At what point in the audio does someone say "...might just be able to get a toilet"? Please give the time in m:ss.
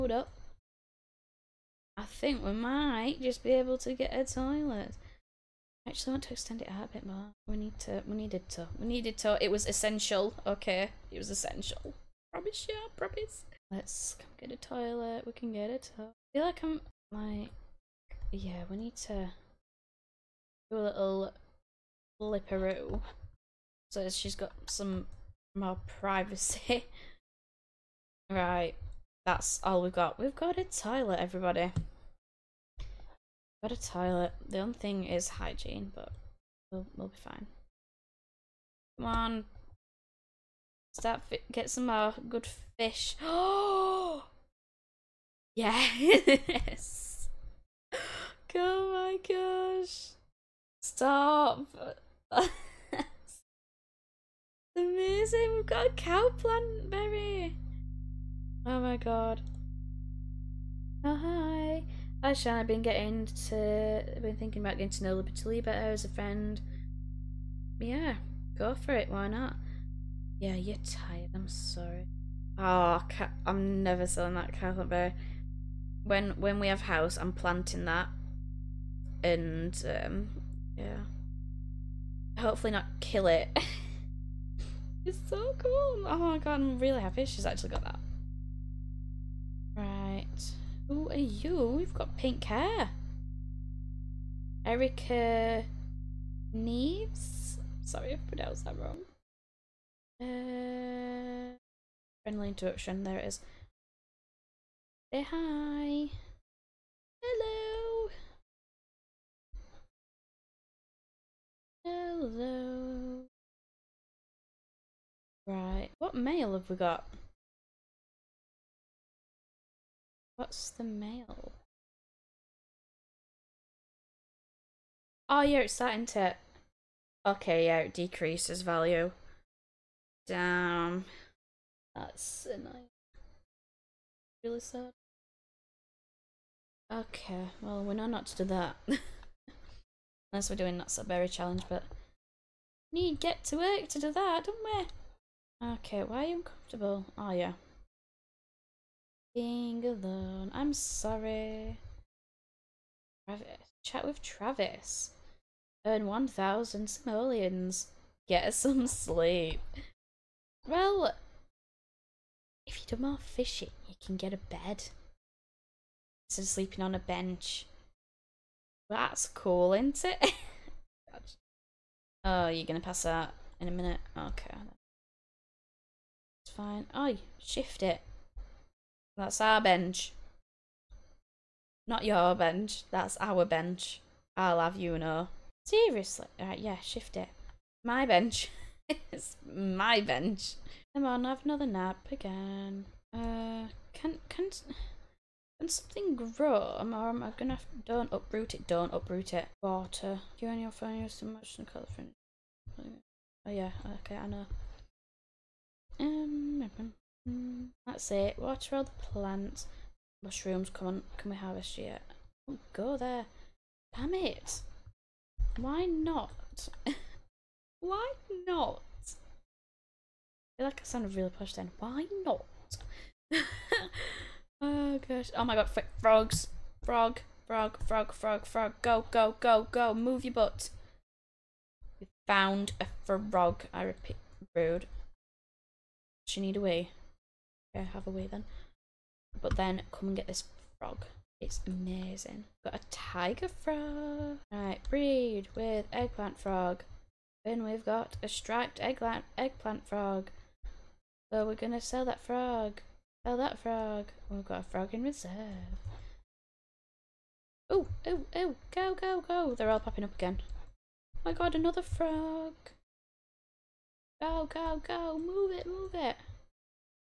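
0:02.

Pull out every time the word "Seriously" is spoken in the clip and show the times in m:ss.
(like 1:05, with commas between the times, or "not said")
3:05.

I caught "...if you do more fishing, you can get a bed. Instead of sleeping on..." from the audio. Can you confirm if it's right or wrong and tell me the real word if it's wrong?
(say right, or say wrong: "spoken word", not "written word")
right.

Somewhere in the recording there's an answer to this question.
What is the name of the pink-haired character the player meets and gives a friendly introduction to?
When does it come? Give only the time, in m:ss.
1:34.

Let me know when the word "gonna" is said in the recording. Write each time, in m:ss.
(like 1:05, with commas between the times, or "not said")
3:17, 4:11.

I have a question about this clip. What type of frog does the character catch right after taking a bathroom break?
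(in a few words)
Tiger frog.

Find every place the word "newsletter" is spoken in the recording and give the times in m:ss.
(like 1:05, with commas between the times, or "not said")
not said.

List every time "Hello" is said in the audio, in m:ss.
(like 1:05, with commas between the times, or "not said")
1:47, 1:51.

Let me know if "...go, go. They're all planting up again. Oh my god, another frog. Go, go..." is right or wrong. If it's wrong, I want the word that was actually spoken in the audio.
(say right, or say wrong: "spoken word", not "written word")
wrong: "popping", not "planting".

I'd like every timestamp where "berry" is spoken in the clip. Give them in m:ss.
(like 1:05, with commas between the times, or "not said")
0:56, 1:14, 2:21.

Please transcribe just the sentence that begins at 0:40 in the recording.
Start get some more good fish.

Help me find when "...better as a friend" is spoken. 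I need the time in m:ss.
1:05.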